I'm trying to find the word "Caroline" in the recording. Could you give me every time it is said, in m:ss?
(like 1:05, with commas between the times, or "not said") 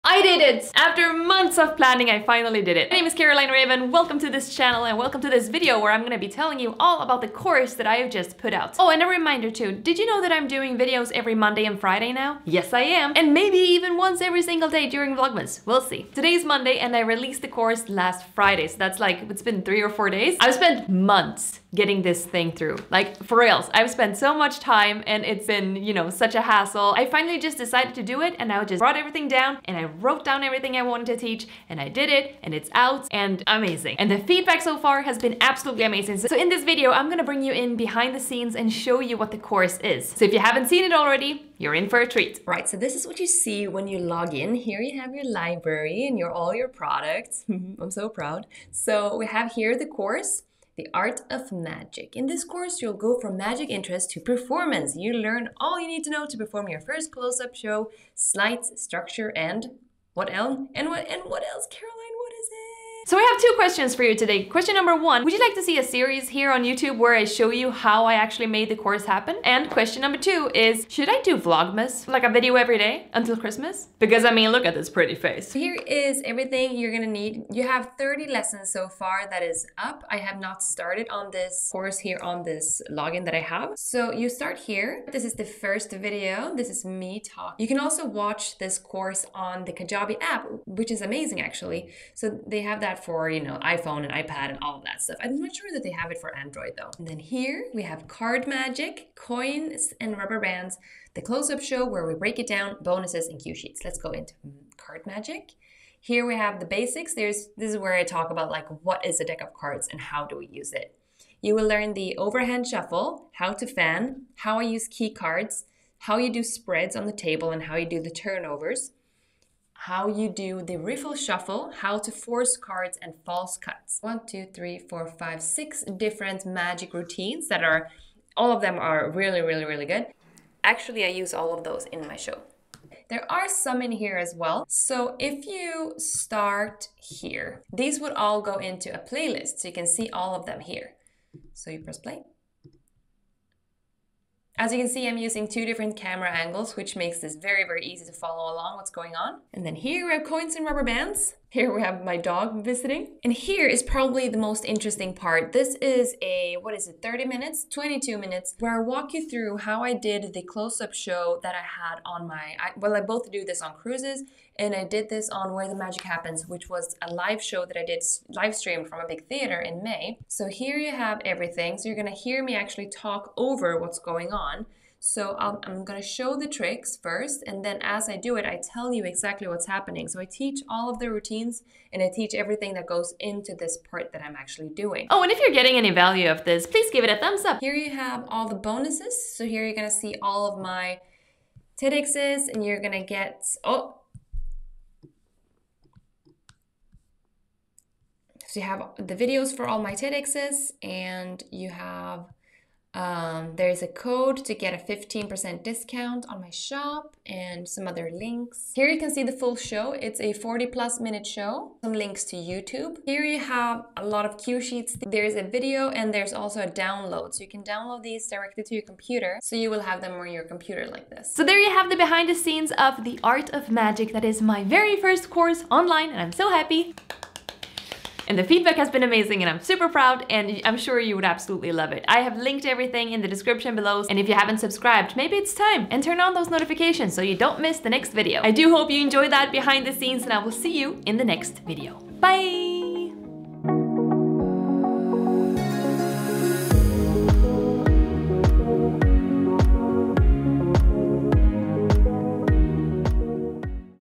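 0:03, 1:01.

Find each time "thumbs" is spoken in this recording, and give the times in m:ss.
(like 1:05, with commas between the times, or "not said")
3:07.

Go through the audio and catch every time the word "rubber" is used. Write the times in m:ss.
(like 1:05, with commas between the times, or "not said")
1:40, 2:30.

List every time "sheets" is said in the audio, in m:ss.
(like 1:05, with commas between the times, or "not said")
1:43, 3:34.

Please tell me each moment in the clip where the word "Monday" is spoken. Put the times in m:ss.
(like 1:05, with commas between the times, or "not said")
0:11, 0:16.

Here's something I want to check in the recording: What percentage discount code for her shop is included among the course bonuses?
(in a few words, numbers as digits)
15%.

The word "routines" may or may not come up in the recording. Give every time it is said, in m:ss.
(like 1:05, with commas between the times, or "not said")
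2:06, 3:01.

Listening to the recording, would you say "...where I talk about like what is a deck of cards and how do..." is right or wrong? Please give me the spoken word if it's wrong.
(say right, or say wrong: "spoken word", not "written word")
right.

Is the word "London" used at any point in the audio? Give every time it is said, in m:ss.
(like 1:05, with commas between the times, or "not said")
not said.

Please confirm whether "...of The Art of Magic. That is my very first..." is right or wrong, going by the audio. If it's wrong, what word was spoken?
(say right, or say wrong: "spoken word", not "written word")
right.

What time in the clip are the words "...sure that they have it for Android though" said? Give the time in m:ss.
1:35.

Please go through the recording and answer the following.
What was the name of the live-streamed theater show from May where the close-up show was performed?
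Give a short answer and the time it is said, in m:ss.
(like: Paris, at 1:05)
Where the Magic Happens, at 2:45.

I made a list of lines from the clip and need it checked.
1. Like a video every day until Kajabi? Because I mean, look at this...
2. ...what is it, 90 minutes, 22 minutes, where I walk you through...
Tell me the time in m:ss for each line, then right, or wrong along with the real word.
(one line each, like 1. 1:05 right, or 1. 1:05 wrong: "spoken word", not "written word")
1. 1:12 wrong: "Christmas", not "Kajabi"
2. 2:36 wrong: "30", not "90".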